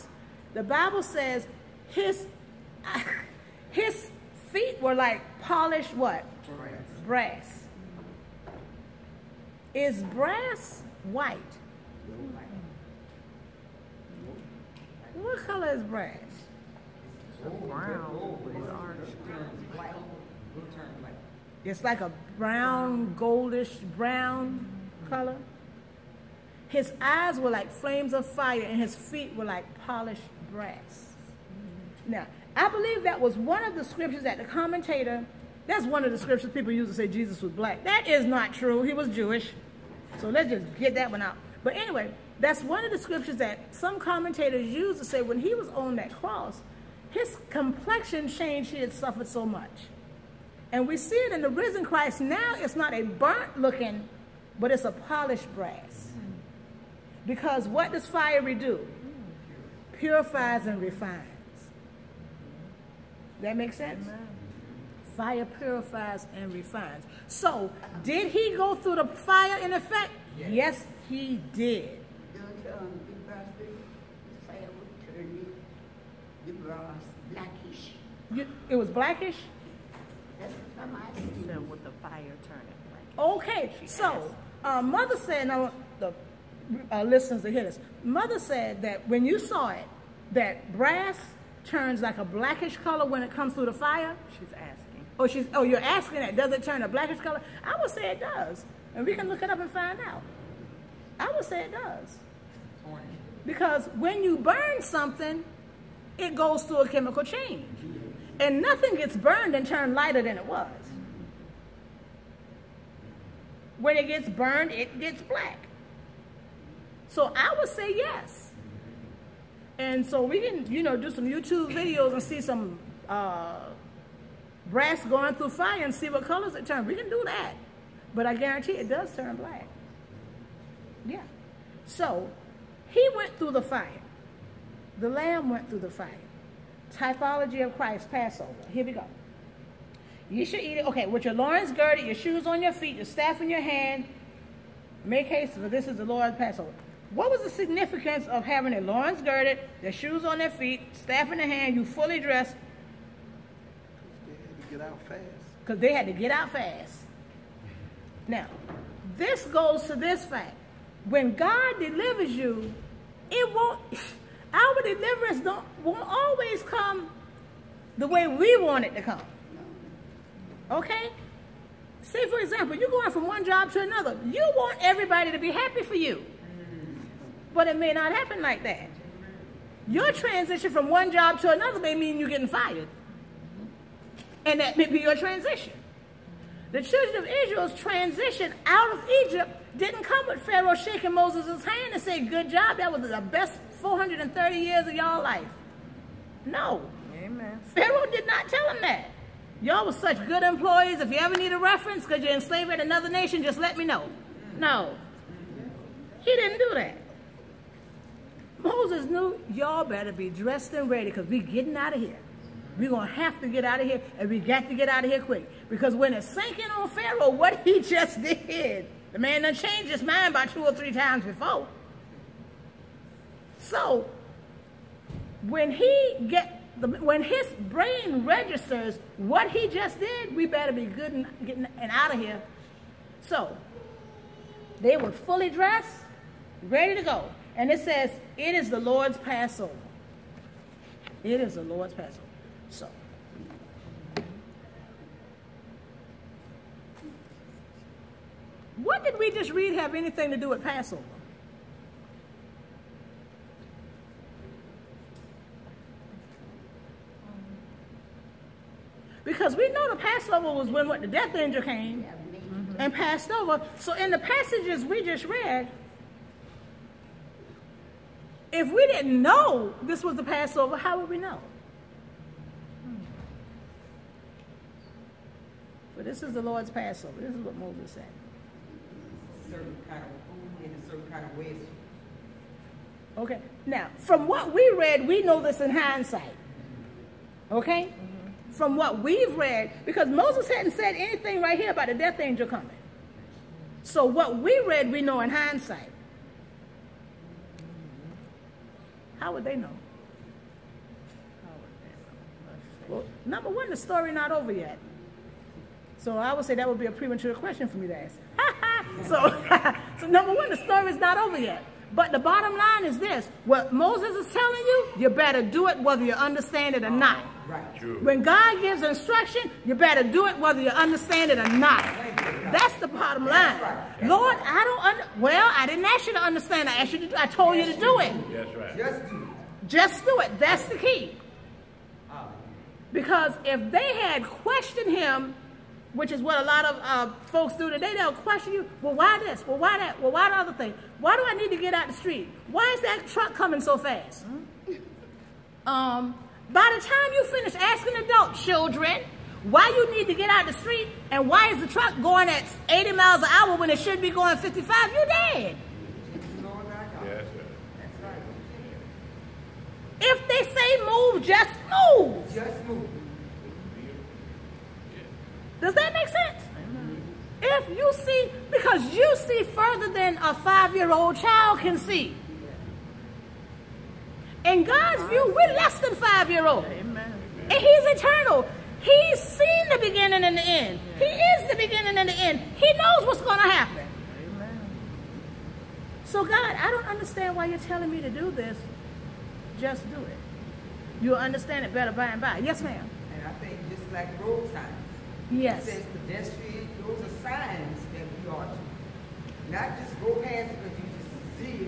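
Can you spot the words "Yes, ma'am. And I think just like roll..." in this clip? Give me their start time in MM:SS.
06:32.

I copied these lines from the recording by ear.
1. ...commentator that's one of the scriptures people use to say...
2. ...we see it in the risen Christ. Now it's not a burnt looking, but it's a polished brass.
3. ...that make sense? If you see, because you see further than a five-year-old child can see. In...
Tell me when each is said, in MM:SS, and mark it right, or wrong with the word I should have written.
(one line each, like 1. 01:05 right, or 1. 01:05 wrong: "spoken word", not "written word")
1. 00:34 right
2. 00:50 right
3. 06:05 right.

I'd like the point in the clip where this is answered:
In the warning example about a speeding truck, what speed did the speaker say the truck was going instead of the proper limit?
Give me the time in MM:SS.
05:52.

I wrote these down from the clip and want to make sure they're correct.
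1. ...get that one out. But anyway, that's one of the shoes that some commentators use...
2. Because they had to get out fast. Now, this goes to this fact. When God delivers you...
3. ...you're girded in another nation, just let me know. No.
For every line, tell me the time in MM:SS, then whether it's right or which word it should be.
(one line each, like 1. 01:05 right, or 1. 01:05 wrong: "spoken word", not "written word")
1. 00:40 wrong: "scriptures", not "shoes"
2. 02:35 right
3. 03:22 wrong: "enslaved", not "girded".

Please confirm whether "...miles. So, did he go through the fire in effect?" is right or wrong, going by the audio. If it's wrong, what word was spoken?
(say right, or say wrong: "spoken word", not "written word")
wrong: "refines", not "miles".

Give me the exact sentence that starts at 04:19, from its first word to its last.
Because we know the Passover was when what the death angel came and passed over.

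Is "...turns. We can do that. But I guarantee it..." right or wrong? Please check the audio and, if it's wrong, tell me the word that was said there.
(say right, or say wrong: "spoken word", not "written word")
right.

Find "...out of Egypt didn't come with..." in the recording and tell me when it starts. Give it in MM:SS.
03:08.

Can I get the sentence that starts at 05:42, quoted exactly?
Why is that truck coming so fast?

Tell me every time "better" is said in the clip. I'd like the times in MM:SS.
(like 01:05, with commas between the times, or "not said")
03:29, 03:50, 05:15, 05:19, 06:31.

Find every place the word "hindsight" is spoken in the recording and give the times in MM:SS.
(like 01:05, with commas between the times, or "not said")
04:45, 04:55.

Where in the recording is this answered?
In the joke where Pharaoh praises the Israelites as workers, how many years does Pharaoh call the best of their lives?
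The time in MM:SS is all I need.
03:13.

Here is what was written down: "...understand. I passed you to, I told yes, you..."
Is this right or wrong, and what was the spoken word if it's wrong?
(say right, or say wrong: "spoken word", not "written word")
wrong: "asked", not "passed".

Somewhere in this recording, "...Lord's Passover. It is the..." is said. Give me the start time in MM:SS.
03:58.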